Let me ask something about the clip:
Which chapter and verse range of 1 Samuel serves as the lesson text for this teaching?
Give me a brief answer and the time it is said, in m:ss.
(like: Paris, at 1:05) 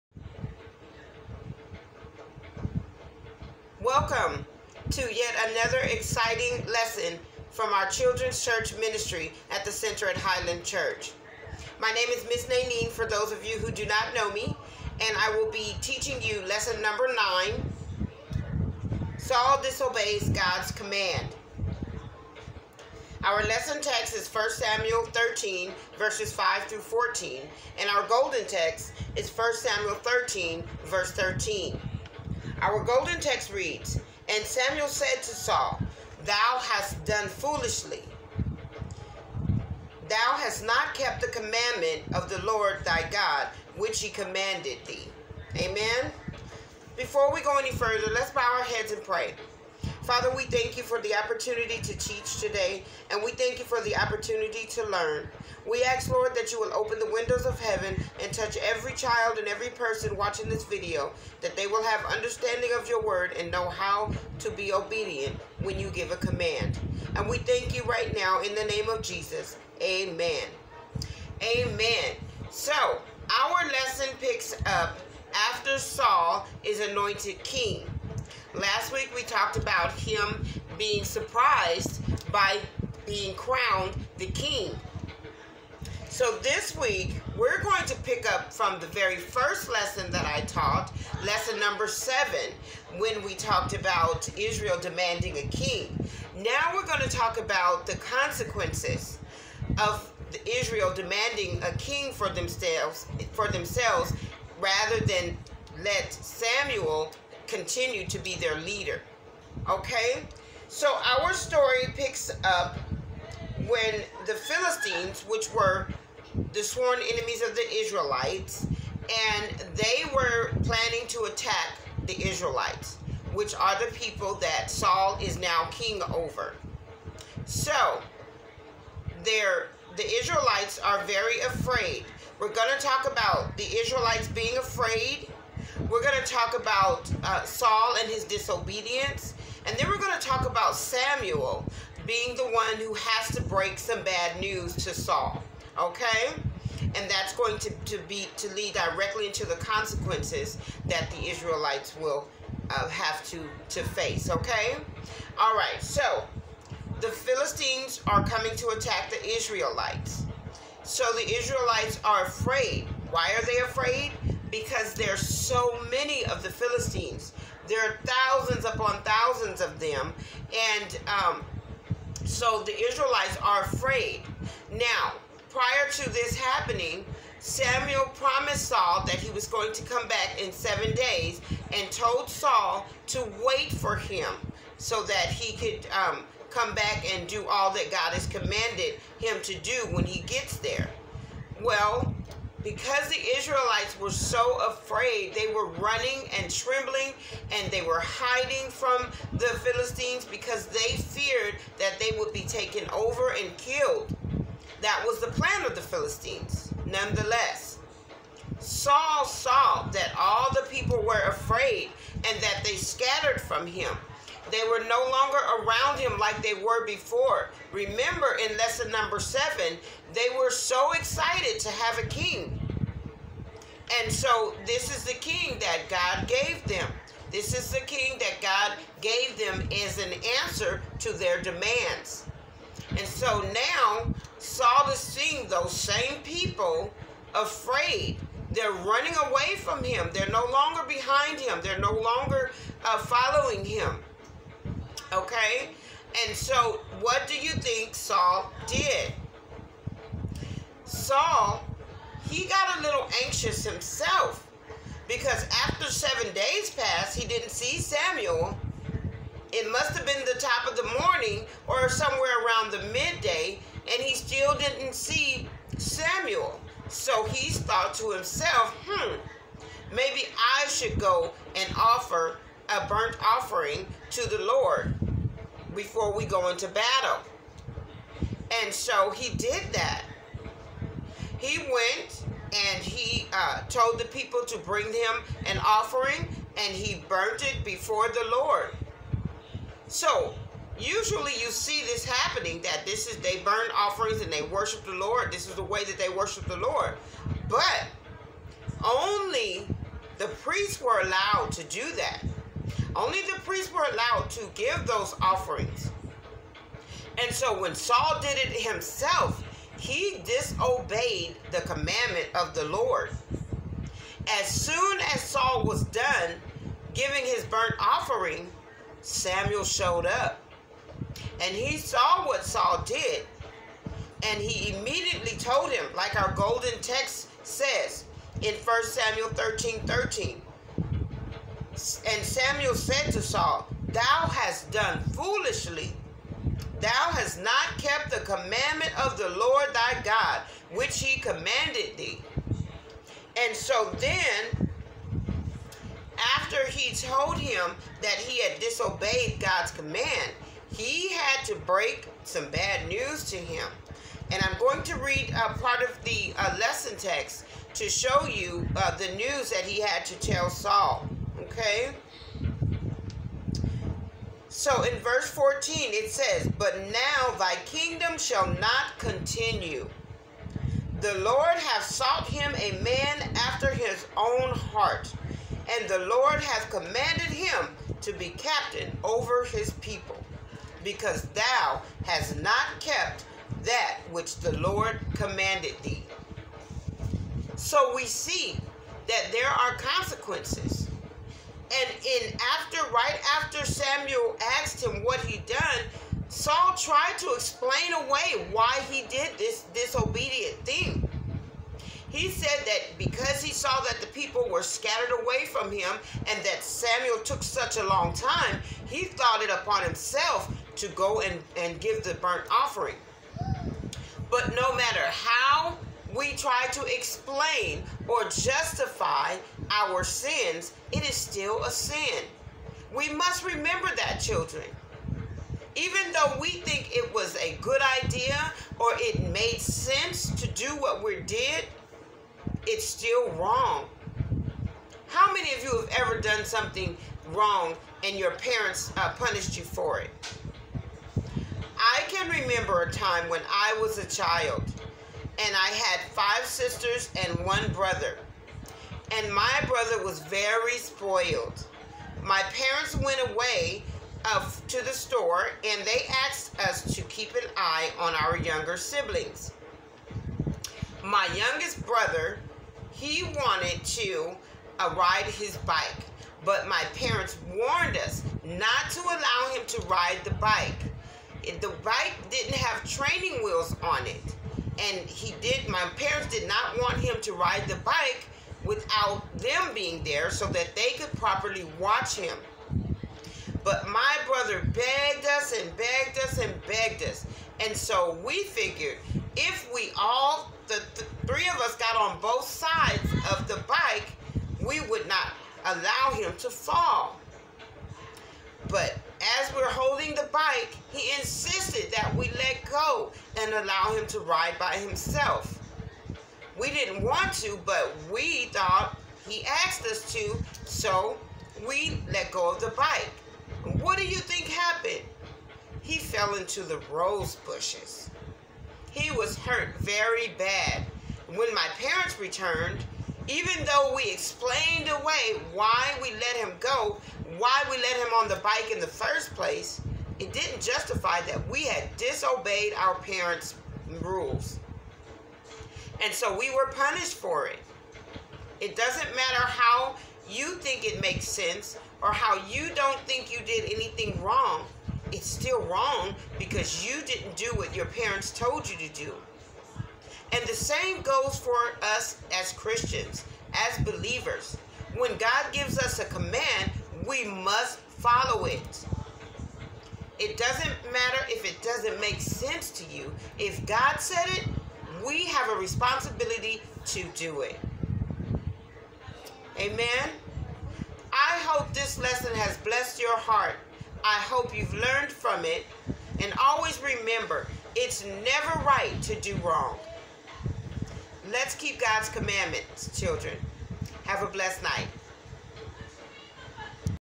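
13:5-14, at 0:24.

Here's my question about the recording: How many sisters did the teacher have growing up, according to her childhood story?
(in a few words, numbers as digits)
5.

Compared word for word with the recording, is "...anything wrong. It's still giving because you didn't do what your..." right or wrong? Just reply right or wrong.
wrong.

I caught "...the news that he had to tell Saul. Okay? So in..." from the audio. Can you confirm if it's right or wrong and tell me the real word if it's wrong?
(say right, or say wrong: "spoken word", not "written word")
right.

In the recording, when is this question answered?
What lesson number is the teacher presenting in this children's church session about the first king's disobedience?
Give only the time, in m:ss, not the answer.
0:16.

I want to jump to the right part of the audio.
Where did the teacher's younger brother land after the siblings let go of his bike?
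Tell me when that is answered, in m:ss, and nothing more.
8:36.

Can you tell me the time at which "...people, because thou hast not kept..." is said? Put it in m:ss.
6:19.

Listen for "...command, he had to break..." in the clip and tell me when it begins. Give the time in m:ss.
5:49.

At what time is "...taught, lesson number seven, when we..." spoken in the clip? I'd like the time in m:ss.
1:30.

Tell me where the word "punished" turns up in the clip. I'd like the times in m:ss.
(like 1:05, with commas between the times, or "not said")
7:19, 8:56.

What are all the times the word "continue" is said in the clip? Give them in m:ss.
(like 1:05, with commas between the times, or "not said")
1:47, 6:08.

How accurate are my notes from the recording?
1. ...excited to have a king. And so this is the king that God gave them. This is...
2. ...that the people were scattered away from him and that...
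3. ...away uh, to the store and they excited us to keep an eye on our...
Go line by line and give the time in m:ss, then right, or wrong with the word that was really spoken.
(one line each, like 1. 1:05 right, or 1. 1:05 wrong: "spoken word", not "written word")
1. 3:40 right
2. 6:43 right
3. 7:33 wrong: "asked", not "excited".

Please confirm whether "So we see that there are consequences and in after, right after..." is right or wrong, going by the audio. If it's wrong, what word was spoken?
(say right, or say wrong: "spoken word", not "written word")
right.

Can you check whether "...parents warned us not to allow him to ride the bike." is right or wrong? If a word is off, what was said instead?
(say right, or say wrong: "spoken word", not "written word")
right.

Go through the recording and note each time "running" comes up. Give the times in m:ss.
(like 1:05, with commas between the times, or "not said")
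3:15, 3:58.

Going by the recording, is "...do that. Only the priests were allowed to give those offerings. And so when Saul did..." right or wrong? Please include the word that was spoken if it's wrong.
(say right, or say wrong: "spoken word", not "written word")
right.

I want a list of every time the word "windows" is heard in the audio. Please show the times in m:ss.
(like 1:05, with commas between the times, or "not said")
0:57.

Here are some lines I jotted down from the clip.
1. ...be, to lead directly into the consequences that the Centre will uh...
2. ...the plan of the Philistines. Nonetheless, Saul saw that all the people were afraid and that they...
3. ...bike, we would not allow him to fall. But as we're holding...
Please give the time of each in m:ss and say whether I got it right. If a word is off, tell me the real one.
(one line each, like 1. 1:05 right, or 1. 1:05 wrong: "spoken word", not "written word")
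1. 2:28 wrong: "Israelites", not "Centre"
2. 3:25 right
3. 8:13 right.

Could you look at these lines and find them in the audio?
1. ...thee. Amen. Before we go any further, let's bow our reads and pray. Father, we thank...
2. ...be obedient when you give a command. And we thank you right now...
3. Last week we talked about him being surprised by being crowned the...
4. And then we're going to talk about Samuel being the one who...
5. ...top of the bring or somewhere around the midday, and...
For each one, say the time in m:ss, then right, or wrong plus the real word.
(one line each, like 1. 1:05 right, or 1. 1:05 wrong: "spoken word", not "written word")
1. 0:44 wrong: "heads", not "reads"
2. 1:04 right
3. 1:18 right
4. 2:19 right
5. 4:20 wrong: "morning", not "bring".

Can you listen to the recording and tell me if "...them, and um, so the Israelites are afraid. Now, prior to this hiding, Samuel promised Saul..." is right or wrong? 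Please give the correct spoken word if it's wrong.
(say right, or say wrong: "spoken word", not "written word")
wrong: "happening", not "hiding".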